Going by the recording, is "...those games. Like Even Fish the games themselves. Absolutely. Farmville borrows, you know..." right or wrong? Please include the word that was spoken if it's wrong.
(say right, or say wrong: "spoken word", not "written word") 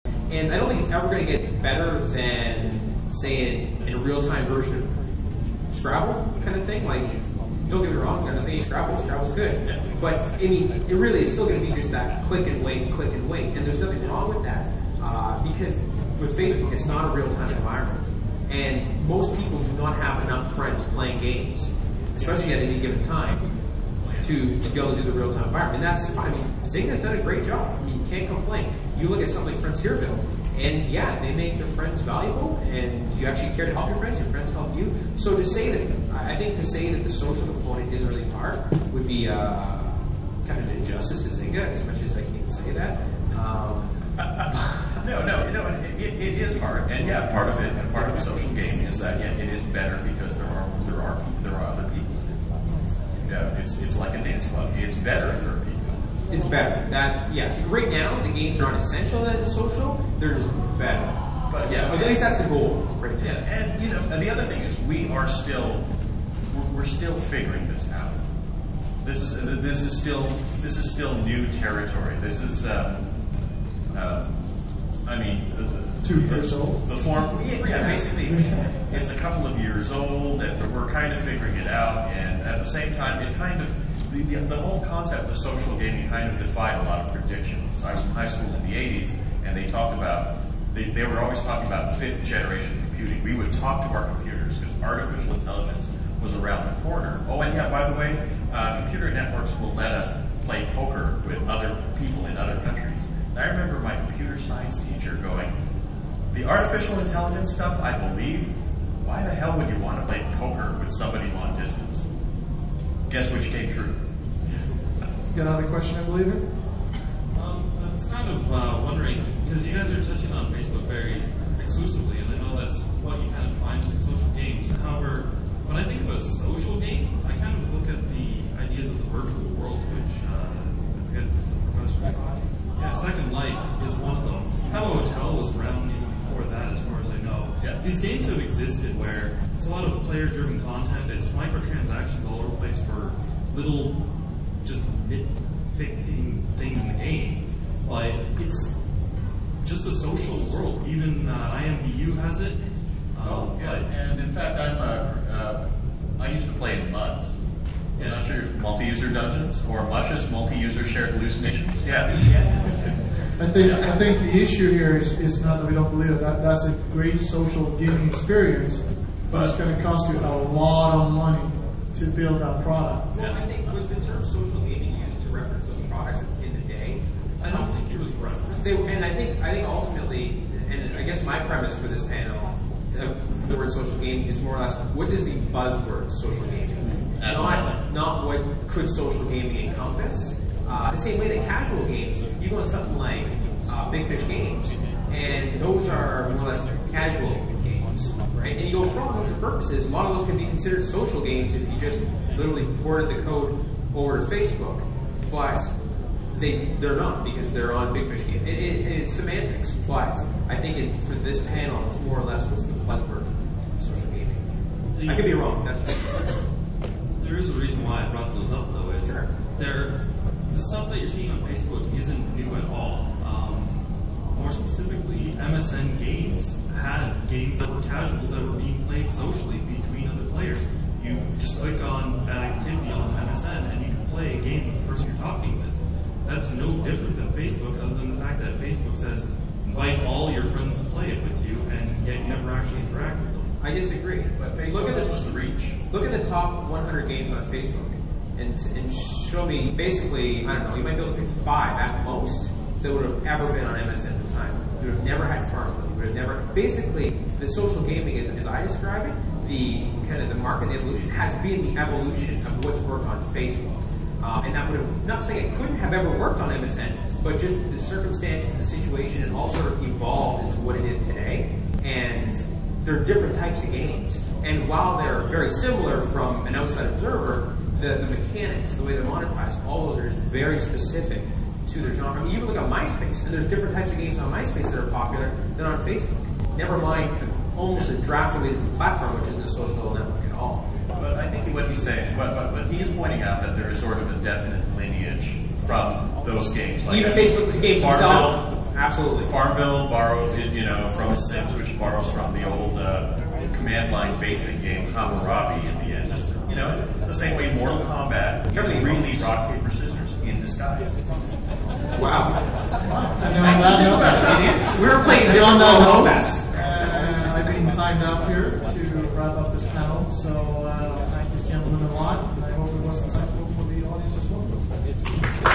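wrong: "Facebook", not "Fish".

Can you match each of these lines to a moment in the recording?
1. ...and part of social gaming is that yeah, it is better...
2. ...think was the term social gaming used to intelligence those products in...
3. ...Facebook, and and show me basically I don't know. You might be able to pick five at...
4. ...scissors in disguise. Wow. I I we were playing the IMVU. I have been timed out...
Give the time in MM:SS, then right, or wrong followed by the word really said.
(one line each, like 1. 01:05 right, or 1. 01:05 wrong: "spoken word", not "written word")
1. 00:47 right
2. 02:53 wrong: "reference", not "intelligence"
3. 04:07 right
4. 05:09 wrong: "Kombat", not "IMVU".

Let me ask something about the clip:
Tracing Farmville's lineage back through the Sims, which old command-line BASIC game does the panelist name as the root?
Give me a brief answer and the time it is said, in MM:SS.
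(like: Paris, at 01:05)
Hammurabi, at 05:04.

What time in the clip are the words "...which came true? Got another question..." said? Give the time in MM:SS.
01:53.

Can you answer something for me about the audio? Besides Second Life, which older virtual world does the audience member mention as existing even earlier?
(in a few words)
Habbo Hotel.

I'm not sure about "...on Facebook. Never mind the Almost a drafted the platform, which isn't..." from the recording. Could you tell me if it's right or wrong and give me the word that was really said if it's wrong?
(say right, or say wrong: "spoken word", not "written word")
right.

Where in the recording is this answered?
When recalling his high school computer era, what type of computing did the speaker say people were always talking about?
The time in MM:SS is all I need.
01:31.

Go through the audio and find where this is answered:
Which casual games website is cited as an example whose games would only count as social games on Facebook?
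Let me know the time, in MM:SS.
03:13.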